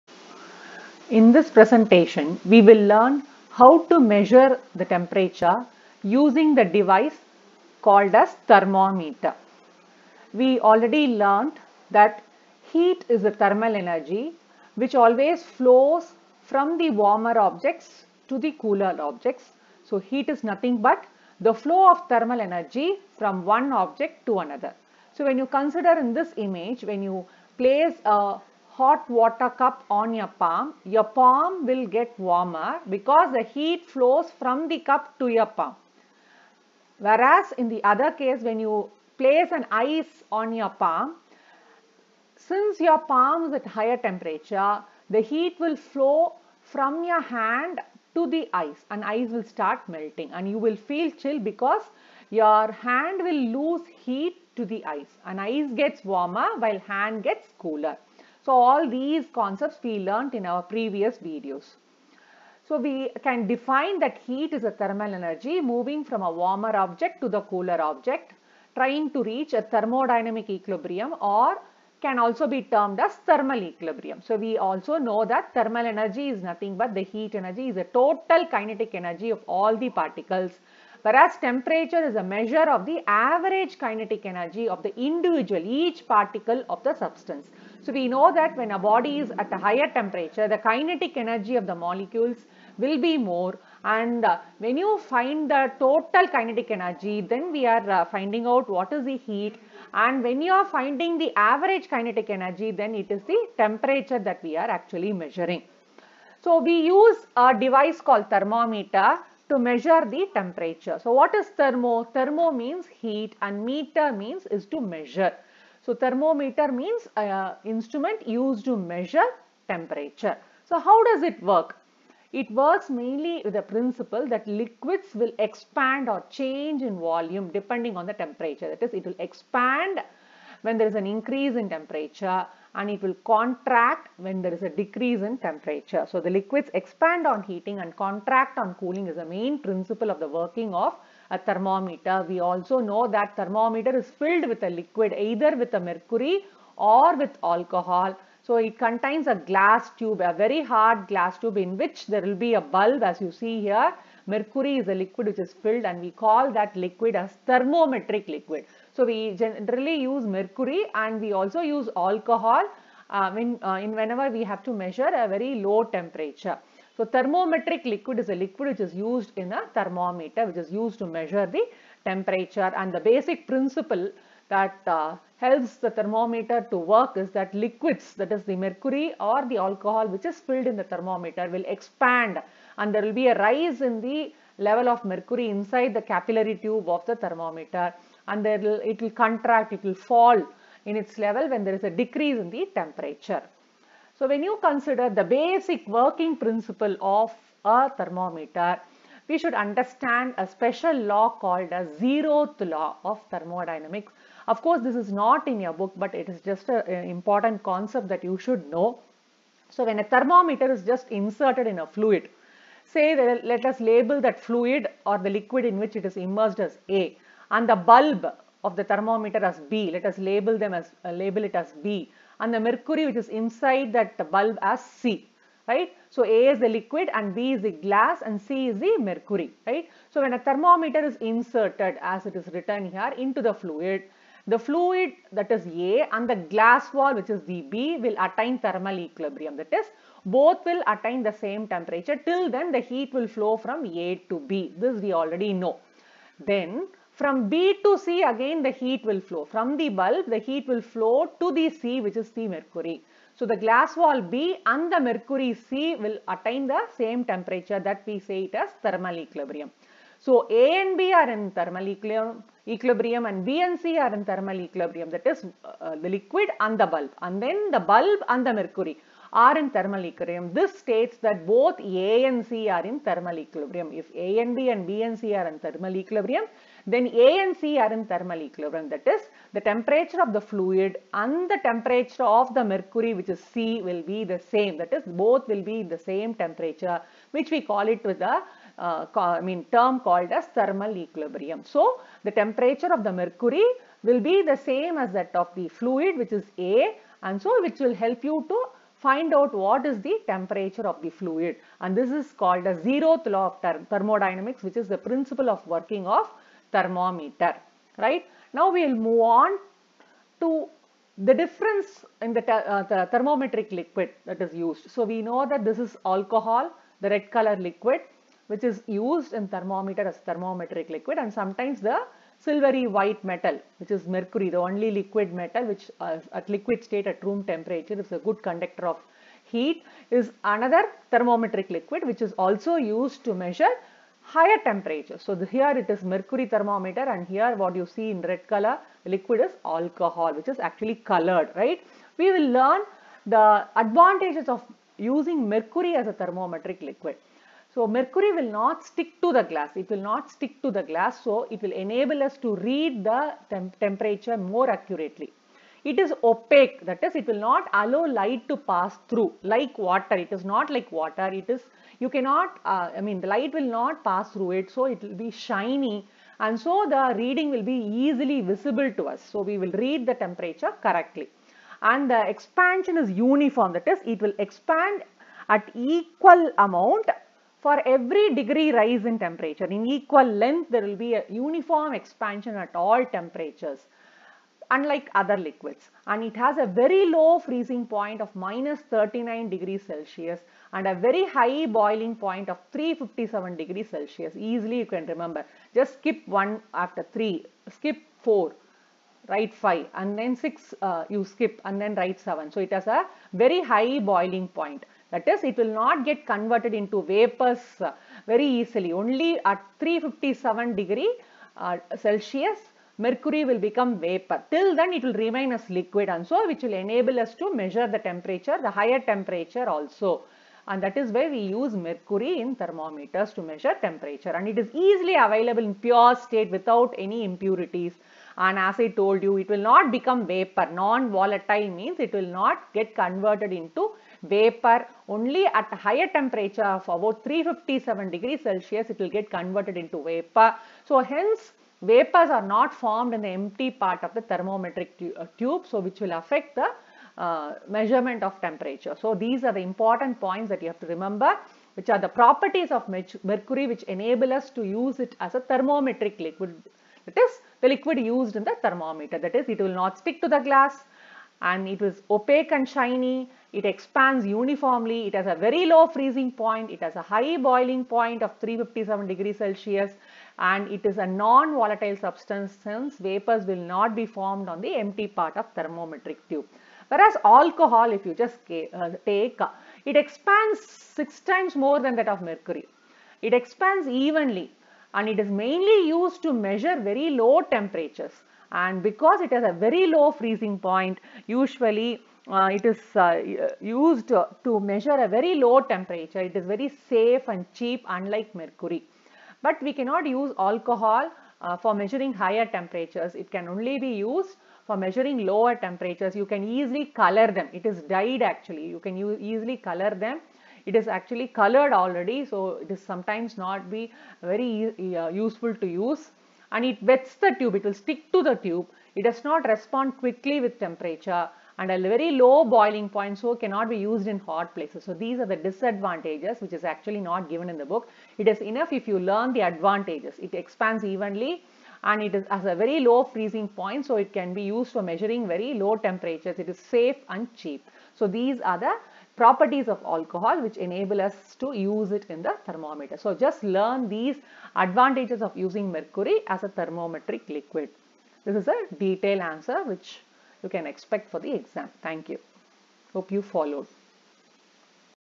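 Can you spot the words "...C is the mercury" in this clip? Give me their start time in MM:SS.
03:48.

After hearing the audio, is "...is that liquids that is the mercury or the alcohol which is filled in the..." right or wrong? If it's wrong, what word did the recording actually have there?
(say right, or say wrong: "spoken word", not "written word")
right.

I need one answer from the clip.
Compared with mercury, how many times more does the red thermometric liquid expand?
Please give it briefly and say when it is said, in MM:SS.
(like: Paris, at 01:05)
six times, at 08:00.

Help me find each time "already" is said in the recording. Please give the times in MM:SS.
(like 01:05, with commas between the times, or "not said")
00:10, 04:05, 08:31.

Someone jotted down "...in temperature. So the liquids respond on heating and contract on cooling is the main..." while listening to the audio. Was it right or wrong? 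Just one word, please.
wrong.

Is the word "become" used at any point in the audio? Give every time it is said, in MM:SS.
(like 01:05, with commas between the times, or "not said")
06:53, 07:09.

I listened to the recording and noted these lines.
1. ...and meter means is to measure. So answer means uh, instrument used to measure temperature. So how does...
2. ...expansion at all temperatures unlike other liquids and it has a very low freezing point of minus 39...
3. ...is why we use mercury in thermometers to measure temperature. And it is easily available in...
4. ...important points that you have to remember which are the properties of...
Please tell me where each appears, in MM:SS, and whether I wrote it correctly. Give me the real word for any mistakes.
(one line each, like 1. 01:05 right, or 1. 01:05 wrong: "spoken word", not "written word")
1. 01:53 wrong: "thermometer", not "answer"
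2. 06:21 right
3. 07:00 right
4. 07:29 right.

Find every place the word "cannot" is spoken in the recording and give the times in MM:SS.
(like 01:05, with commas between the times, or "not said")
06:02, 08:19, 08:43.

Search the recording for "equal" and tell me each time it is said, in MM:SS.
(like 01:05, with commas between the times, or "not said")
06:15, 06:19.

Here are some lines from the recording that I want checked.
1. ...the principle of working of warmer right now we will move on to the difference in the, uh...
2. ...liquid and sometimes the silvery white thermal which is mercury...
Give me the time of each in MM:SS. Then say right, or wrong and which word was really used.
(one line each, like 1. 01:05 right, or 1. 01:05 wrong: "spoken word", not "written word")
1. 05:04 wrong: "thermometer", not "warmer"
2. 05:20 wrong: "metal", not "thermal".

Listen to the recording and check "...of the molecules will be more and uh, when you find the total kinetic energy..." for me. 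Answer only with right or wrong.
right.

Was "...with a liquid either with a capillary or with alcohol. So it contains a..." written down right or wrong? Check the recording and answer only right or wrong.
wrong.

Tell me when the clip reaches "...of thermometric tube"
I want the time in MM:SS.
07:55.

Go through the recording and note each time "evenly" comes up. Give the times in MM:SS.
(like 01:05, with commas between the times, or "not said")
08:03, 08:50.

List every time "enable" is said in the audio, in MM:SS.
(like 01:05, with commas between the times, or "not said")
05:51, 06:56, 07:33, 09:00.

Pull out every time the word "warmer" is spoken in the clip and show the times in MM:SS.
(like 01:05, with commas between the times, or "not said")
00:16, 00:32, 00:56, 01:06.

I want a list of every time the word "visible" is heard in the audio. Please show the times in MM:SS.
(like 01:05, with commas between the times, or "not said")
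06:08.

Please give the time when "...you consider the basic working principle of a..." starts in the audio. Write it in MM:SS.
03:14.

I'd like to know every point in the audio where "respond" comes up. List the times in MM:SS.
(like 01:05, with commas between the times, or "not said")
08:39.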